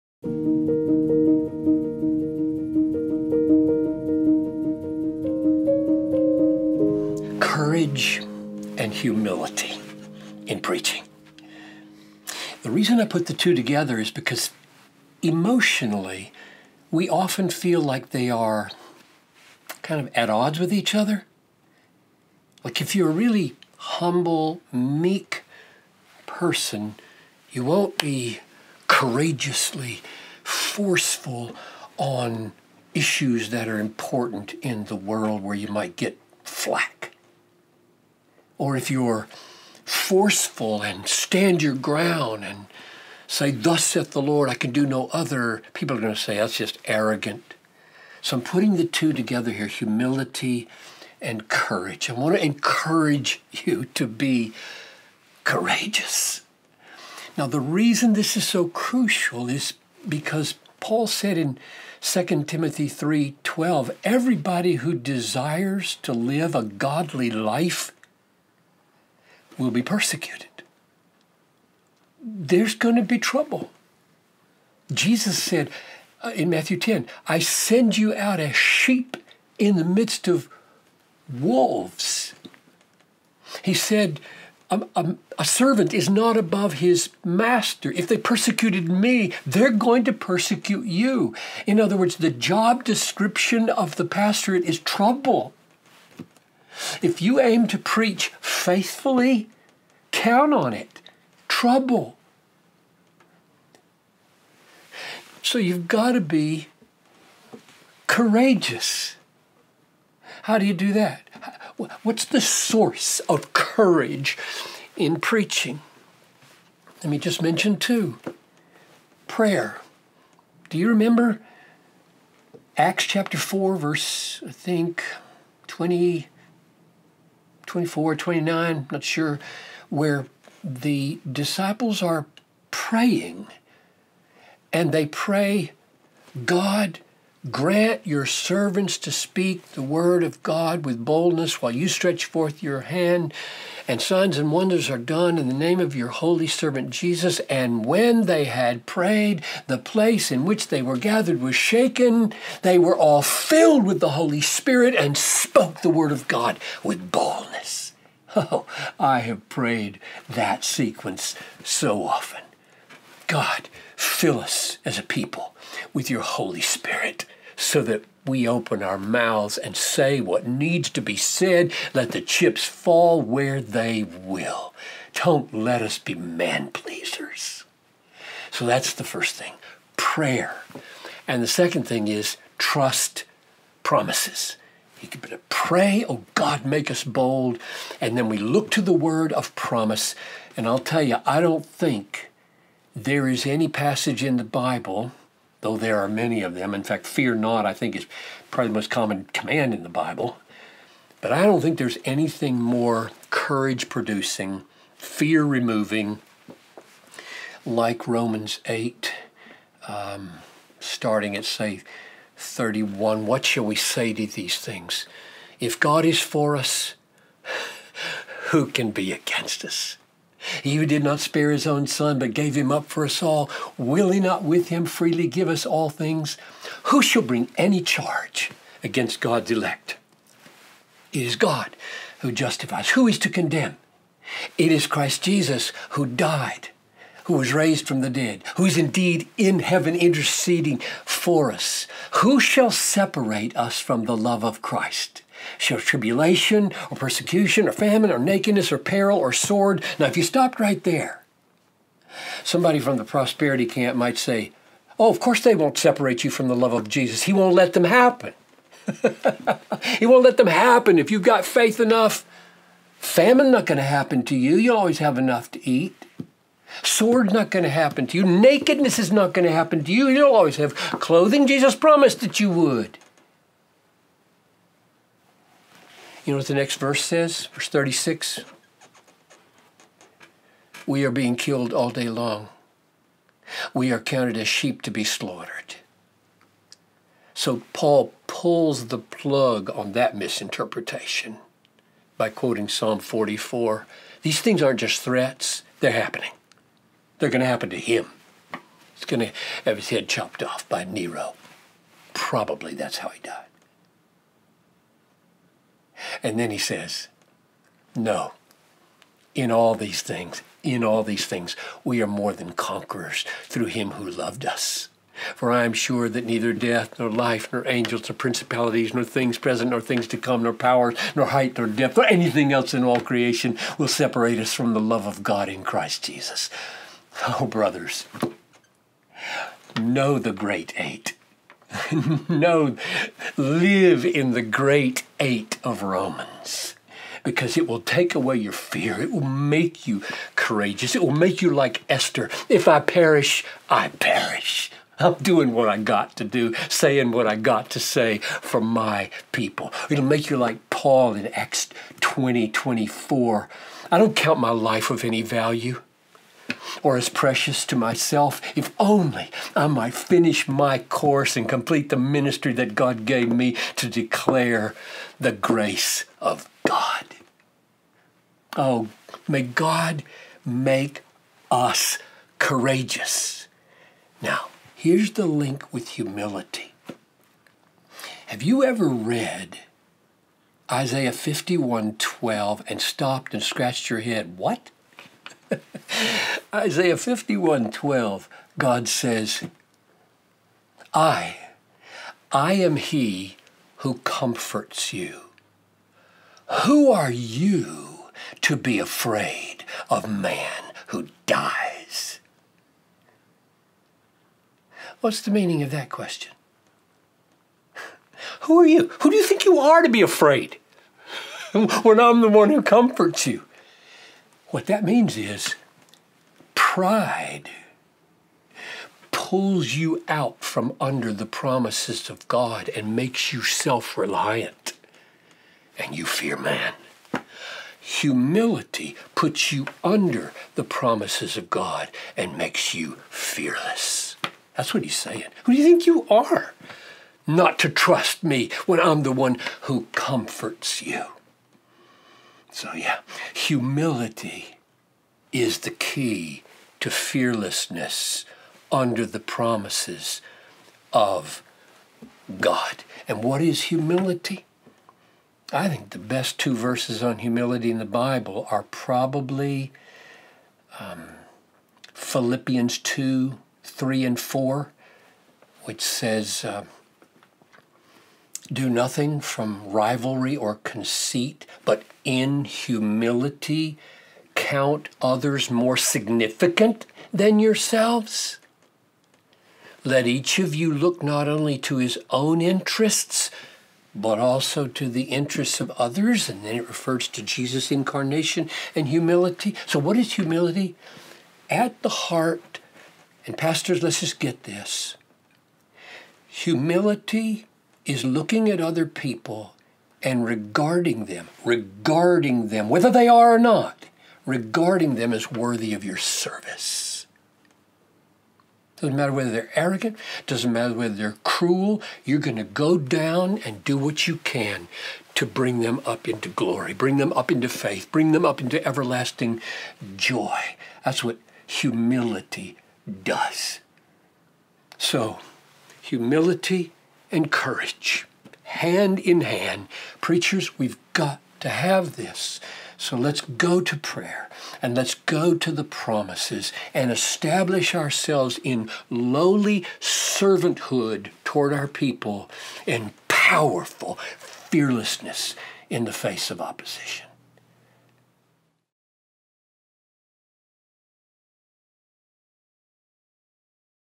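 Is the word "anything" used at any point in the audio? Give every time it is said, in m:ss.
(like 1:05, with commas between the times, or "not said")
3:22, 5:22.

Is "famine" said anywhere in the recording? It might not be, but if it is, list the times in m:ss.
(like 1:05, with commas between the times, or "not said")
4:07, 4:22.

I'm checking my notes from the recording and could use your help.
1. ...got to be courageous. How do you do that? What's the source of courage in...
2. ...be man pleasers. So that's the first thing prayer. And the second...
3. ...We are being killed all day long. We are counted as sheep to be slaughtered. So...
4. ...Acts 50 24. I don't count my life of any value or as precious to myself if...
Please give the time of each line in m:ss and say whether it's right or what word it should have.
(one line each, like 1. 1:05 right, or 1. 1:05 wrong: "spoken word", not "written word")
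1. 1:45 right
2. 2:55 right
3. 4:40 right
4. 5:51 wrong: "20", not "50".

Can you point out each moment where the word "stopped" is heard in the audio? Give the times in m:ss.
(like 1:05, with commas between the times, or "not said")
4:10, 6:22.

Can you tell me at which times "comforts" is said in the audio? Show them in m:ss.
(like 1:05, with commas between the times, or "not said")
6:34, 6:52, 7:19.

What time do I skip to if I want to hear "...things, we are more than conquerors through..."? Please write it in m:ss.
5:11.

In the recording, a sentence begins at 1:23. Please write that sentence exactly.
He said, a, a, a, servant is not above his master.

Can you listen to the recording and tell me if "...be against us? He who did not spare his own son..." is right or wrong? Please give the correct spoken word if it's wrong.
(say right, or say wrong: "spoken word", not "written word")
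right.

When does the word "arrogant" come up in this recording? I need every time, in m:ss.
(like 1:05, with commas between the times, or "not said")
0:46, 8:29.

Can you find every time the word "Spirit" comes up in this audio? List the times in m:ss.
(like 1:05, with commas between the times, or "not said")
2:34, 2:46.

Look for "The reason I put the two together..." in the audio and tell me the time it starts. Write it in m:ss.
0:12.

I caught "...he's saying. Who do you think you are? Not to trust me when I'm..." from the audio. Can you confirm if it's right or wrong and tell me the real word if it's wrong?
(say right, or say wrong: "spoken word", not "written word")
right.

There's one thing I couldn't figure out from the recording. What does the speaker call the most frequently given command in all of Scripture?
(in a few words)
Fear not.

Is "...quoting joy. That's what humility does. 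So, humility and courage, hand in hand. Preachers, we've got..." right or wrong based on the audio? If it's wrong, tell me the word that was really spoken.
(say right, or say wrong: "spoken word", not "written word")
wrong: "everlasting", not "quoting".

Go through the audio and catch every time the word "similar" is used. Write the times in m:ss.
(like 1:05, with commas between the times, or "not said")
not said.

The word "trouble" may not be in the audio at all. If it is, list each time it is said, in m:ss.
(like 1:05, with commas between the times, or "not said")
1:13, 1:34, 1:41.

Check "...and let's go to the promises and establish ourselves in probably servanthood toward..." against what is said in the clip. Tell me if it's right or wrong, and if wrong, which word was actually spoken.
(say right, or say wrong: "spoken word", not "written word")
wrong: "lowly", not "probably".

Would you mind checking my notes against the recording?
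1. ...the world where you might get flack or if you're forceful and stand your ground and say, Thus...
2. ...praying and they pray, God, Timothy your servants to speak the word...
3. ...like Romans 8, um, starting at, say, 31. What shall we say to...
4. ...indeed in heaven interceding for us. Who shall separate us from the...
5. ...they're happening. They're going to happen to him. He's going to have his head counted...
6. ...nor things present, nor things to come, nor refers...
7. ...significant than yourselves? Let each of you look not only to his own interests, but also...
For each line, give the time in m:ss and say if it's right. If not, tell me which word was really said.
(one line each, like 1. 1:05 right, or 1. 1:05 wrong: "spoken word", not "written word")
1. 0:34 right
2. 2:12 wrong: "Grant", not "Timothy"
3. 3:27 right
4. 3:58 right
5. 4:55 wrong: "chopped", not "counted"
6. 5:18 wrong: "powers", not "refers"
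7. 7:55 right.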